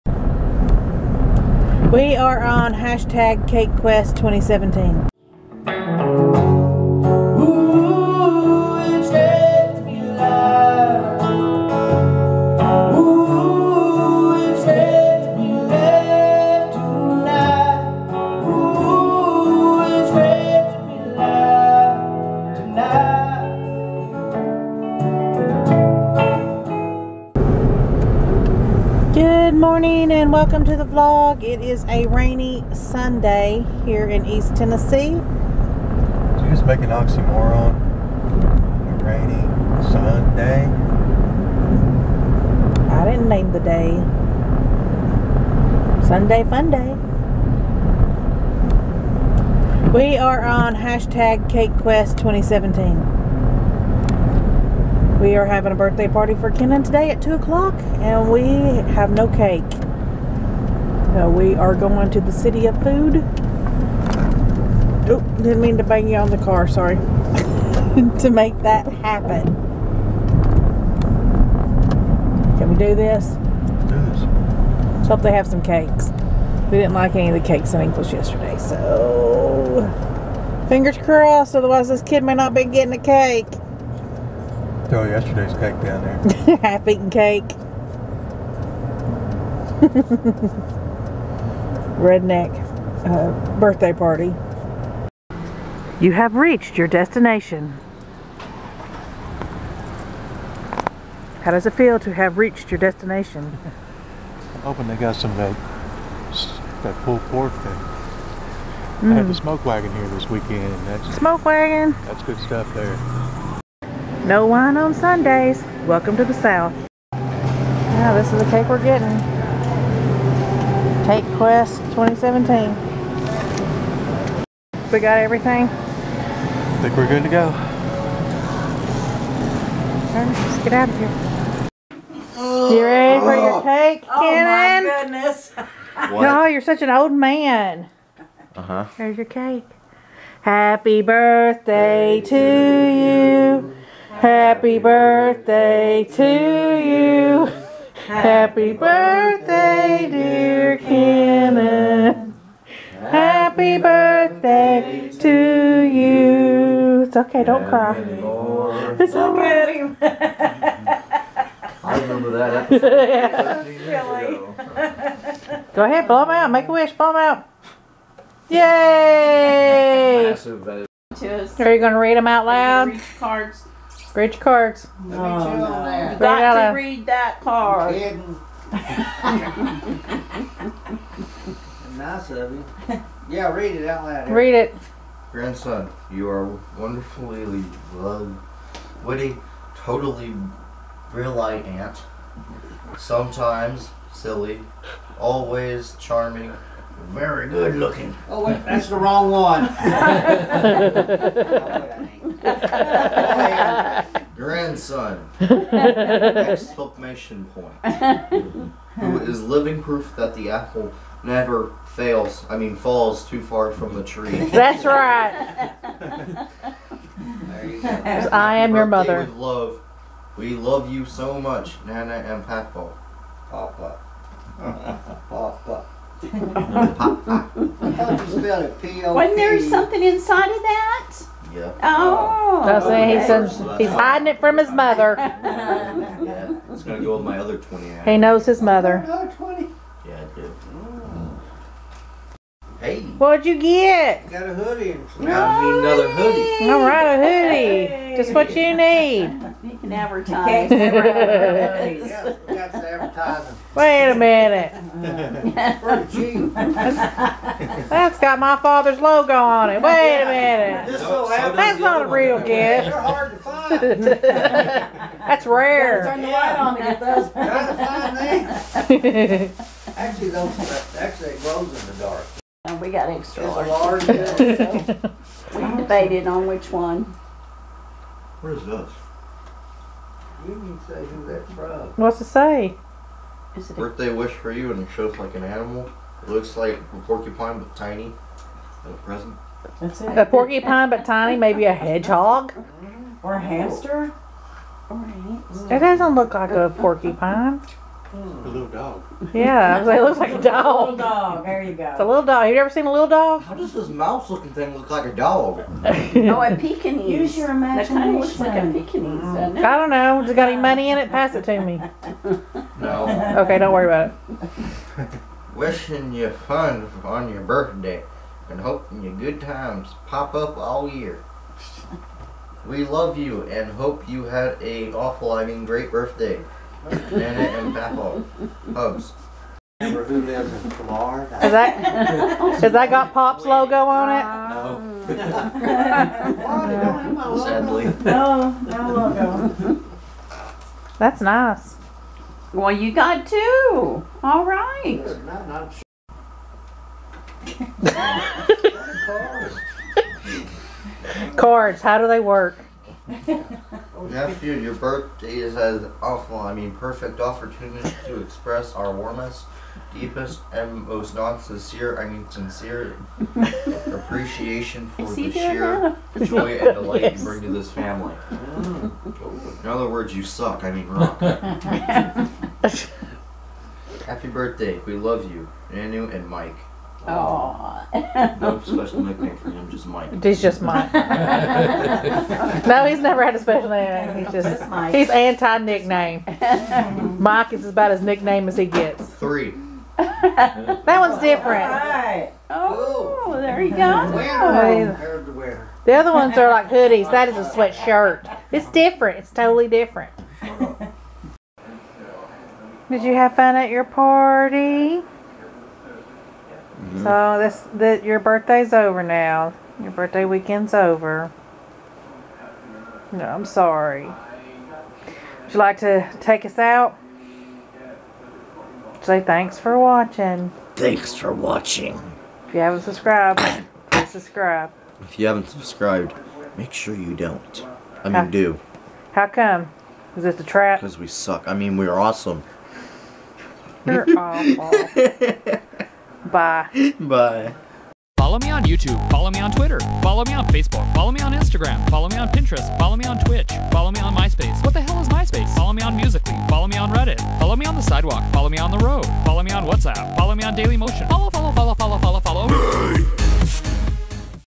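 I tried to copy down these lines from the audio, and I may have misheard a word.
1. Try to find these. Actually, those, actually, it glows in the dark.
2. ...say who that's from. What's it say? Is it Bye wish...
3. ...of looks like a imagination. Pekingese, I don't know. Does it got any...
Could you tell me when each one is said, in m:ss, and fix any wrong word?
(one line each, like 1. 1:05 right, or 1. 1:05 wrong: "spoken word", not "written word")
1. 4:27 right
2. 4:40 wrong: "Birthday", not "Bye"
3. 5:08 right.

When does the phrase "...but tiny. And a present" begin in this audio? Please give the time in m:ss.
4:47.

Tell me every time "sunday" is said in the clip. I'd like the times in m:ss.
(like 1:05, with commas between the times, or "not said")
0:32, 0:39, 0:46, 1:54.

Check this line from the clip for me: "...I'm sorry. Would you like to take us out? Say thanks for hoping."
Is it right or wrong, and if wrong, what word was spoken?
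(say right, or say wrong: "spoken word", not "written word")
wrong: "watching", not "hoping".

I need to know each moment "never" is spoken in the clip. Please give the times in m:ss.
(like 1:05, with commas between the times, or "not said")
3:31, 6:22.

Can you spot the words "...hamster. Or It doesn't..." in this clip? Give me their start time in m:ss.
4:53.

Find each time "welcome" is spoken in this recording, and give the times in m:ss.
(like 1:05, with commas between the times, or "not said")
0:30, 1:55.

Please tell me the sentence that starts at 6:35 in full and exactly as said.
The other ones are like hoodies.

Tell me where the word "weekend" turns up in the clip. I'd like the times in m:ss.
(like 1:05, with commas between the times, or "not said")
1:50, 6:50.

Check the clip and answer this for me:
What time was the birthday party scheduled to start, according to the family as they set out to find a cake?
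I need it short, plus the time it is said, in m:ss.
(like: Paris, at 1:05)
2 o'clock, at 0:57.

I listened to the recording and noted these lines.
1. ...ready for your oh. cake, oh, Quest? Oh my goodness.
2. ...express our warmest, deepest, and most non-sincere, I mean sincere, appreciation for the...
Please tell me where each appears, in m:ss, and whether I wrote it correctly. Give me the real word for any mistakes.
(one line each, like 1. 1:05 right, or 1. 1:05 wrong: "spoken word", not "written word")
1. 2:12 wrong: "Kenan", not "Quest"
2. 5:58 right.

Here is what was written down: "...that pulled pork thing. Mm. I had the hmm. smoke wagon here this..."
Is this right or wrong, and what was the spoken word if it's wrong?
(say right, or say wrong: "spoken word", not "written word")
right.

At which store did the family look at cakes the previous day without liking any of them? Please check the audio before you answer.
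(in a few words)
Ingles.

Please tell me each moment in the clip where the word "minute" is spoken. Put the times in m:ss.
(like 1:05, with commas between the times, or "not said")
4:14, 4:20.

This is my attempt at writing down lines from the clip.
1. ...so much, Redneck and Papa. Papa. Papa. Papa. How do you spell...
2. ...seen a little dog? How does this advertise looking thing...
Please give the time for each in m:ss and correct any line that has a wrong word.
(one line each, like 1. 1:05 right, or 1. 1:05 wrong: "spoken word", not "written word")
1. 3:41 wrong: "Nana", not "Redneck"
2. 5:02 wrong: "mouse", not "advertise".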